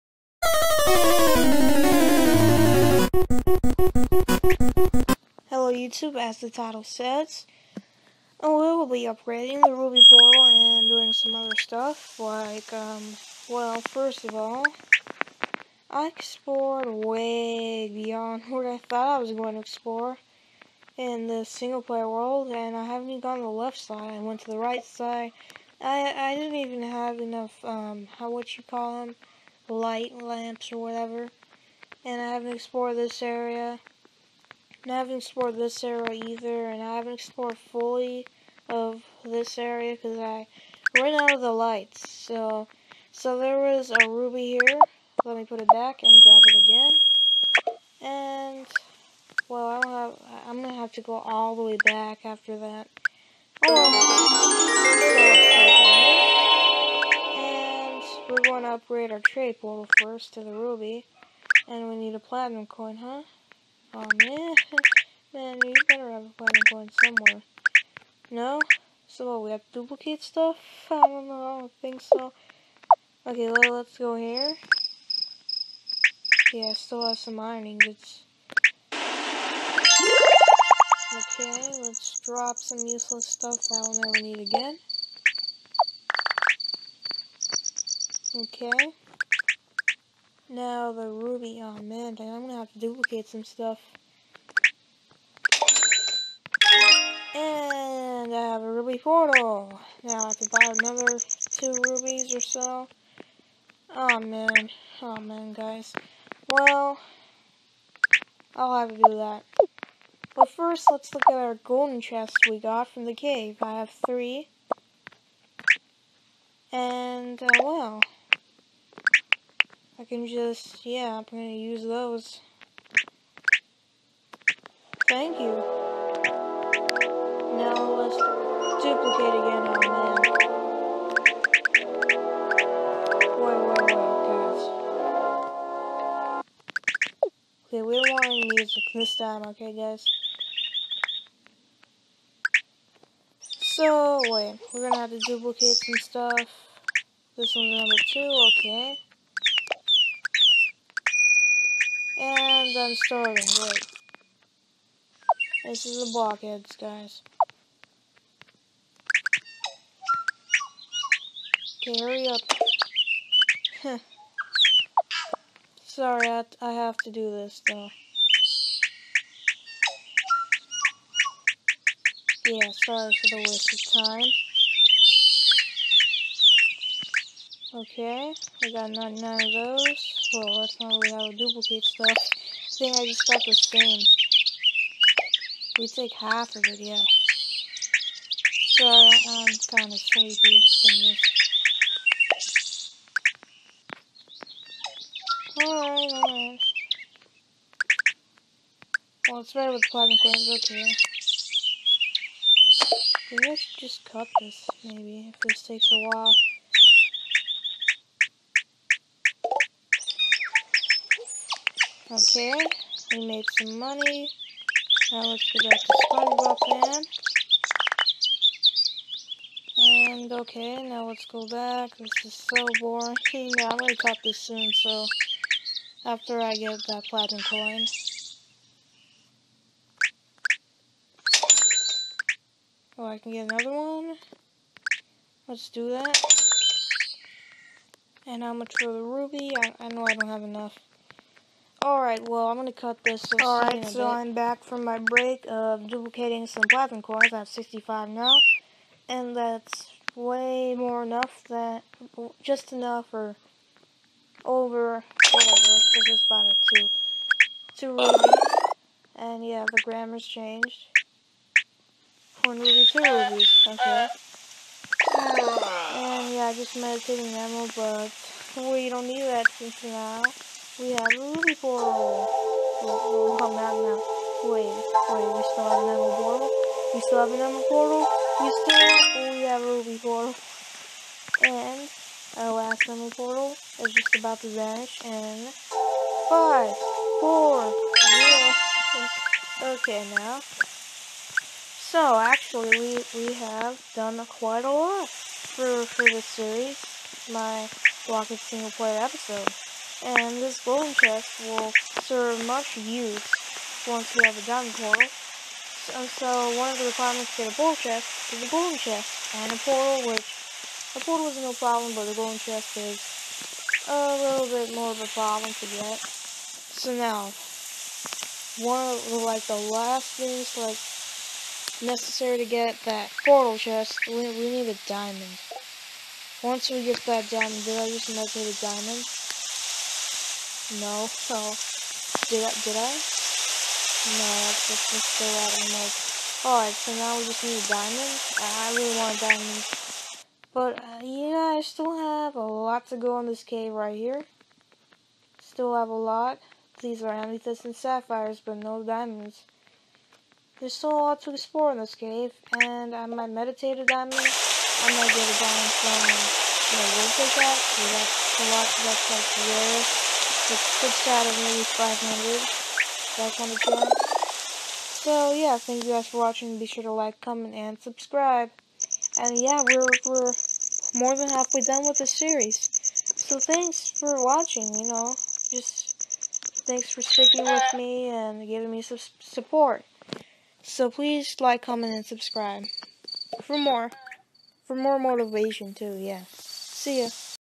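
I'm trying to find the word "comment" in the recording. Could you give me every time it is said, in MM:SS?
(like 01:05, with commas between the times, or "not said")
06:07, 06:21.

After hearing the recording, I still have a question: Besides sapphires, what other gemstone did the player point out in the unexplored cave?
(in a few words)
Amethysts.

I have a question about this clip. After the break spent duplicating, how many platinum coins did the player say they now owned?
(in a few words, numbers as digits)
65.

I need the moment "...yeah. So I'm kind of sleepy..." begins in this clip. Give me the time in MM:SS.
03:06.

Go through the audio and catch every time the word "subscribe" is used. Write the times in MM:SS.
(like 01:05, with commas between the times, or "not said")
06:07, 06:22.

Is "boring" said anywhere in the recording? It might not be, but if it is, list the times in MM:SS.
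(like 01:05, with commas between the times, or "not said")
03:42.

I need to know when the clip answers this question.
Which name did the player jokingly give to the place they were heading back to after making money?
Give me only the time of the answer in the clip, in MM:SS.
03:35.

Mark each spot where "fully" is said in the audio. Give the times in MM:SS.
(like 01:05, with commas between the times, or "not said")
00:37.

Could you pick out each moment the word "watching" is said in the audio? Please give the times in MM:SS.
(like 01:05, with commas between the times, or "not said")
06:06, 06:14.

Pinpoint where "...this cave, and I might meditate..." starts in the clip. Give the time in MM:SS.
05:51.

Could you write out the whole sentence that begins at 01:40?
Now I have to buy another two rubies or so.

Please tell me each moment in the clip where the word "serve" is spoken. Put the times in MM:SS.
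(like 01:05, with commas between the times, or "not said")
05:02.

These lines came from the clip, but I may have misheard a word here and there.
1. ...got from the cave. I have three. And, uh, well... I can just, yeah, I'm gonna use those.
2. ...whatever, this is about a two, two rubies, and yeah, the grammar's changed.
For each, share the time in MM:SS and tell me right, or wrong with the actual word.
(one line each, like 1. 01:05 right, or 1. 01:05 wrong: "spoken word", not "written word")
1. 01:52 right
2. 04:15 right.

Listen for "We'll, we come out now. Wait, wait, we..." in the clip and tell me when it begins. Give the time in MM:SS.
04:32.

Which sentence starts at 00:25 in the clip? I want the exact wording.
I, I didn't even have enough, um, how what you call them, light lamps or whatever and I haven't explored this area.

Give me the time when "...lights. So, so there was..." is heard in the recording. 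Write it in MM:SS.
00:41.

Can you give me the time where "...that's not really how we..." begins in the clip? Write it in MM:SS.
03:00.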